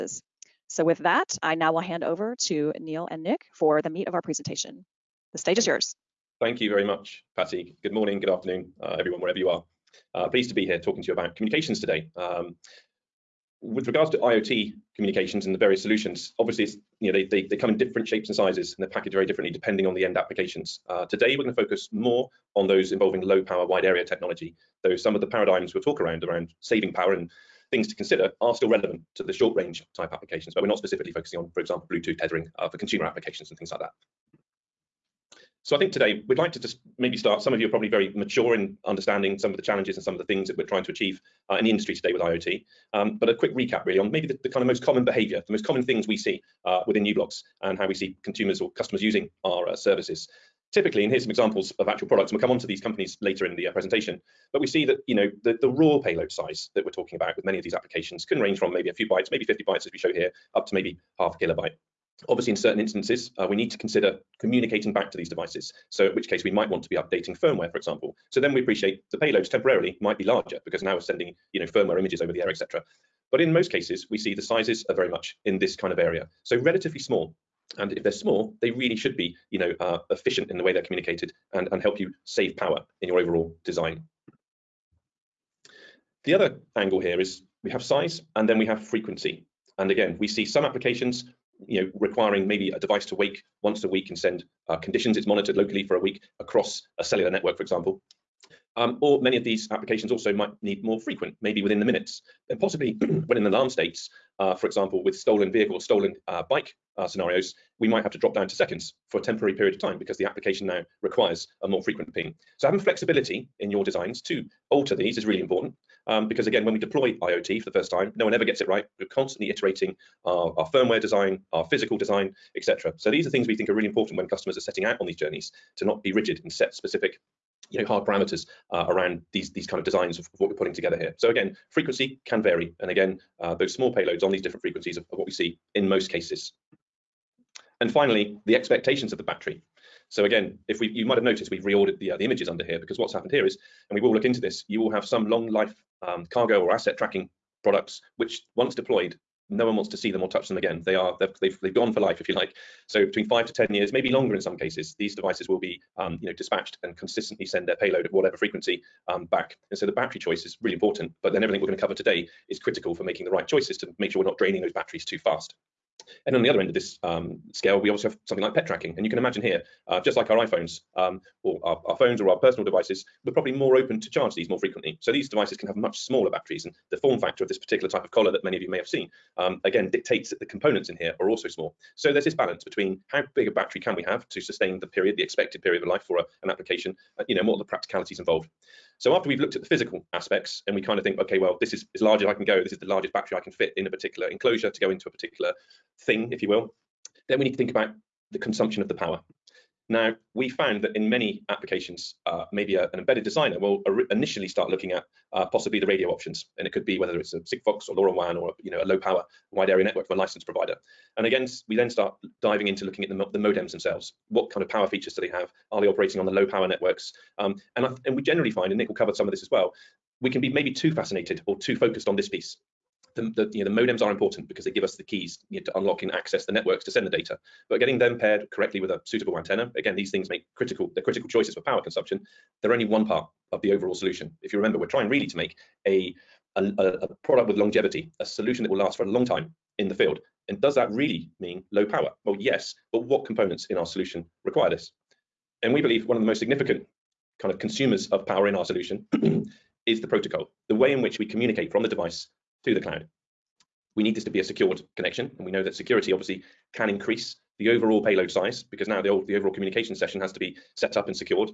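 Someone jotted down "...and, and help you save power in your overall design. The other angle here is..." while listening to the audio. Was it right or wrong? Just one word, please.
right.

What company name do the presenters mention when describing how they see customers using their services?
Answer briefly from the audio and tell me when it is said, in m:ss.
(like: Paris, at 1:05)
u-blox, at 0:47.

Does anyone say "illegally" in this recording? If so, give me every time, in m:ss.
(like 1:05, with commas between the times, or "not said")
not said.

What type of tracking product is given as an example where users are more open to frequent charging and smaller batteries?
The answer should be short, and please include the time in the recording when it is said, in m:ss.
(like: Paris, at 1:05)
pet tracking, at 2:48.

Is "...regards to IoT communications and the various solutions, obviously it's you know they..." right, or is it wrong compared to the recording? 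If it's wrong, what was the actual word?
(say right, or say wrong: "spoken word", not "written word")
right.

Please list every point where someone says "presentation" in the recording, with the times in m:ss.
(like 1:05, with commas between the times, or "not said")
0:04, 0:53.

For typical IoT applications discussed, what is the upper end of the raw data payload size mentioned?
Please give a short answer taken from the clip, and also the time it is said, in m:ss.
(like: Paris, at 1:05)
half a kilobyte, at 1:01.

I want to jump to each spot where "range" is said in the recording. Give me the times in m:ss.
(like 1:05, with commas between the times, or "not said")
0:29, 0:58.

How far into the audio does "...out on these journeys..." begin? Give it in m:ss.
2:04.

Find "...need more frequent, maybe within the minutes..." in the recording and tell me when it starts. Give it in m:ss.
1:40.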